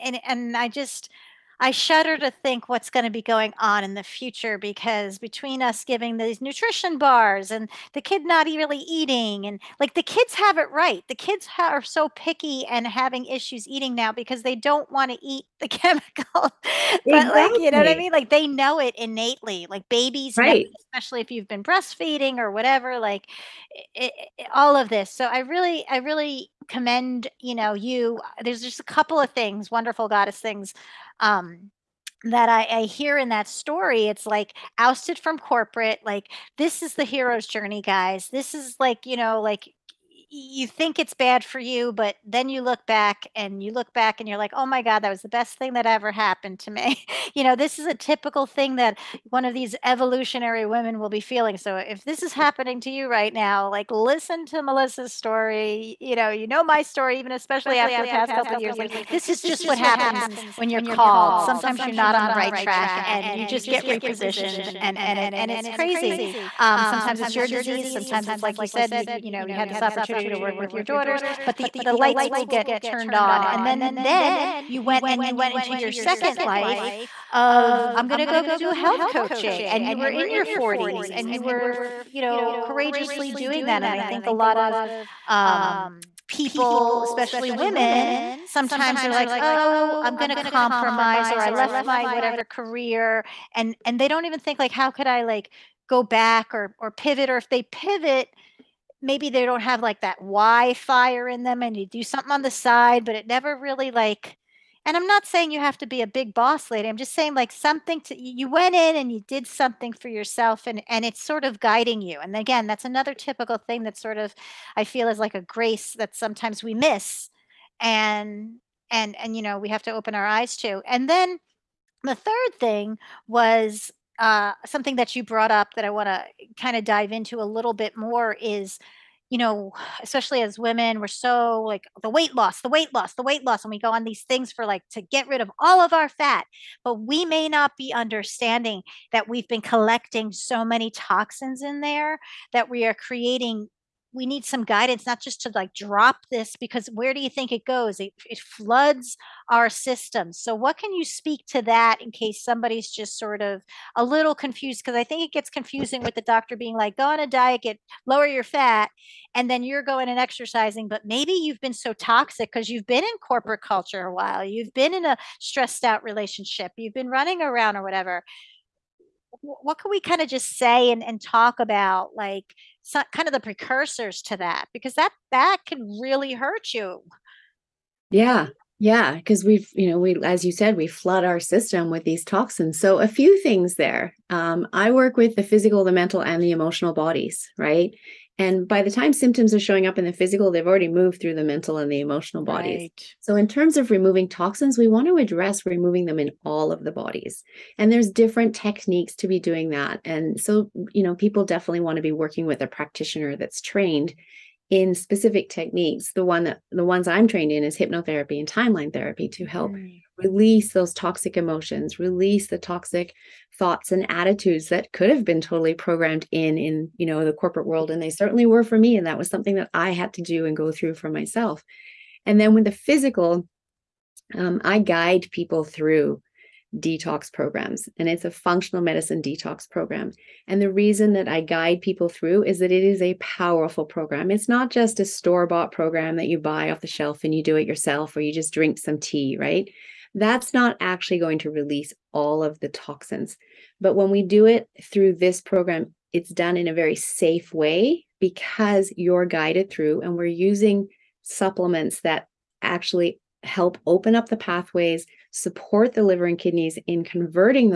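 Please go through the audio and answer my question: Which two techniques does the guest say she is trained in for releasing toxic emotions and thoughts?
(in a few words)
hypnotherapy and timeline therapy.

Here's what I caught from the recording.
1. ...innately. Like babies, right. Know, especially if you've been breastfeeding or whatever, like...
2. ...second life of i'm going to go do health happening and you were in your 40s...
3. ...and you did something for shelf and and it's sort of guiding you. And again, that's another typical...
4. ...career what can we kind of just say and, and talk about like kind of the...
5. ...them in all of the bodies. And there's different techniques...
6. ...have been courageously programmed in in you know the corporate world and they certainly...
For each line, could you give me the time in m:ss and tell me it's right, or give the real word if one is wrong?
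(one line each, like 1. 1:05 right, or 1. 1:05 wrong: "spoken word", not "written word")
1. 0:18 right
2. 1:15 wrong: "coaching", not "happening"
3. 1:48 wrong: "yourself", not "shelf"
4. 2:47 wrong: "whatever", not "career"
5. 3:16 right
6. 3:35 wrong: "totally", not "courageously".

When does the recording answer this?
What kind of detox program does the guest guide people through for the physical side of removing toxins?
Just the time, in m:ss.
3:48.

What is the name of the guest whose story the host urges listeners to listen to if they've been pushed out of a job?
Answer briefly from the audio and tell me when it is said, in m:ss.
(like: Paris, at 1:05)
Melissa, at 0:54.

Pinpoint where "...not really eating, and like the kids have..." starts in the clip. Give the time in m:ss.
0:08.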